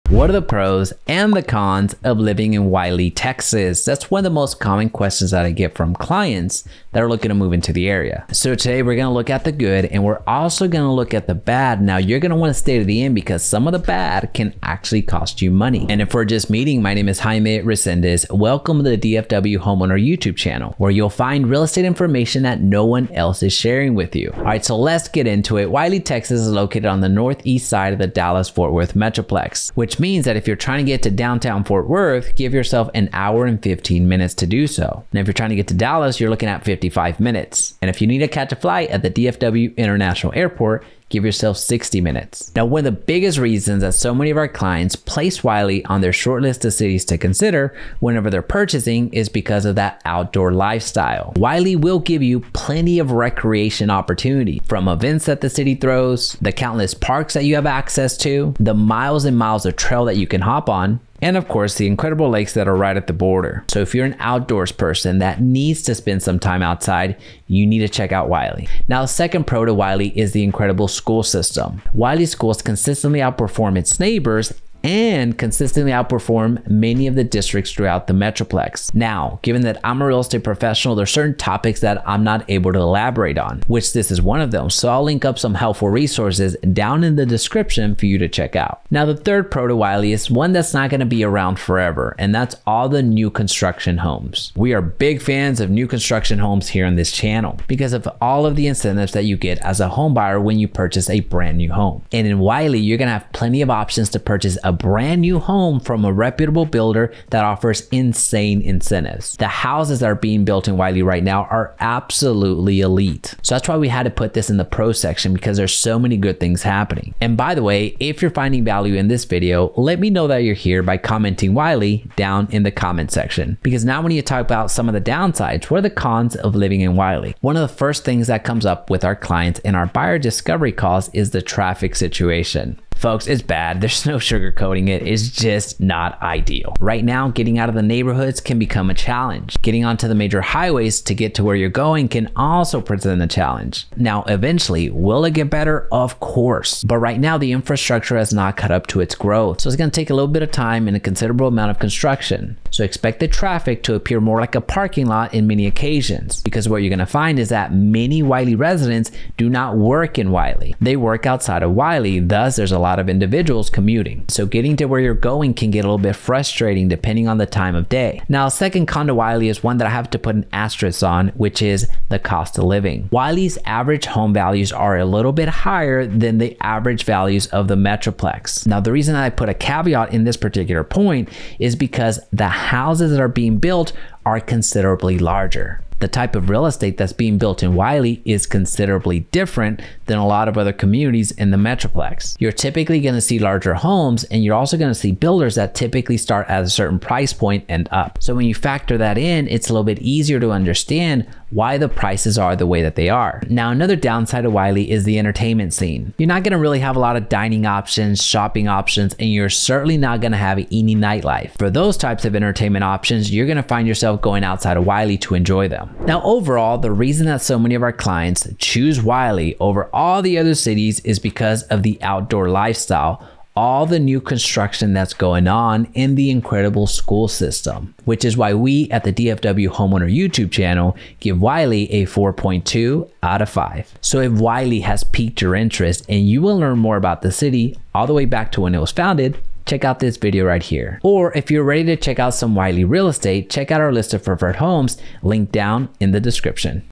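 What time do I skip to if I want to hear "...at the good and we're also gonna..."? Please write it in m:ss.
0:09.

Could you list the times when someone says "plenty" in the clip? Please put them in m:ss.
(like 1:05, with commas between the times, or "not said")
0:52, 1:43.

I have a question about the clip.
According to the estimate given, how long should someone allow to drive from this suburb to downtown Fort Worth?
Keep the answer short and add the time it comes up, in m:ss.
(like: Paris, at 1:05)
1 hour and 15 minutes, at 0:32.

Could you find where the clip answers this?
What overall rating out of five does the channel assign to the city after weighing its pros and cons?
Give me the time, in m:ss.
3:52.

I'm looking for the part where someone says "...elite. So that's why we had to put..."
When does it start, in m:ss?
1:52.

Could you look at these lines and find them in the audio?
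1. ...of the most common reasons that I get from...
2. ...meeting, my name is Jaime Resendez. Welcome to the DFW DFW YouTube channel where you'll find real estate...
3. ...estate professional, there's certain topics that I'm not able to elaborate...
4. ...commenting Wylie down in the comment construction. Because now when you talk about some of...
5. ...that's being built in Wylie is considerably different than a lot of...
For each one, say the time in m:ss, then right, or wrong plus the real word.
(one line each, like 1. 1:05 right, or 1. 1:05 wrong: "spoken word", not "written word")
1. 0:04 wrong: "questions", not "reasons"
2. 0:16 wrong: "Homeowner", not "DFW"
3. 1:20 right
4. 2:00 wrong: "section", not "construction"
5. 3:06 right.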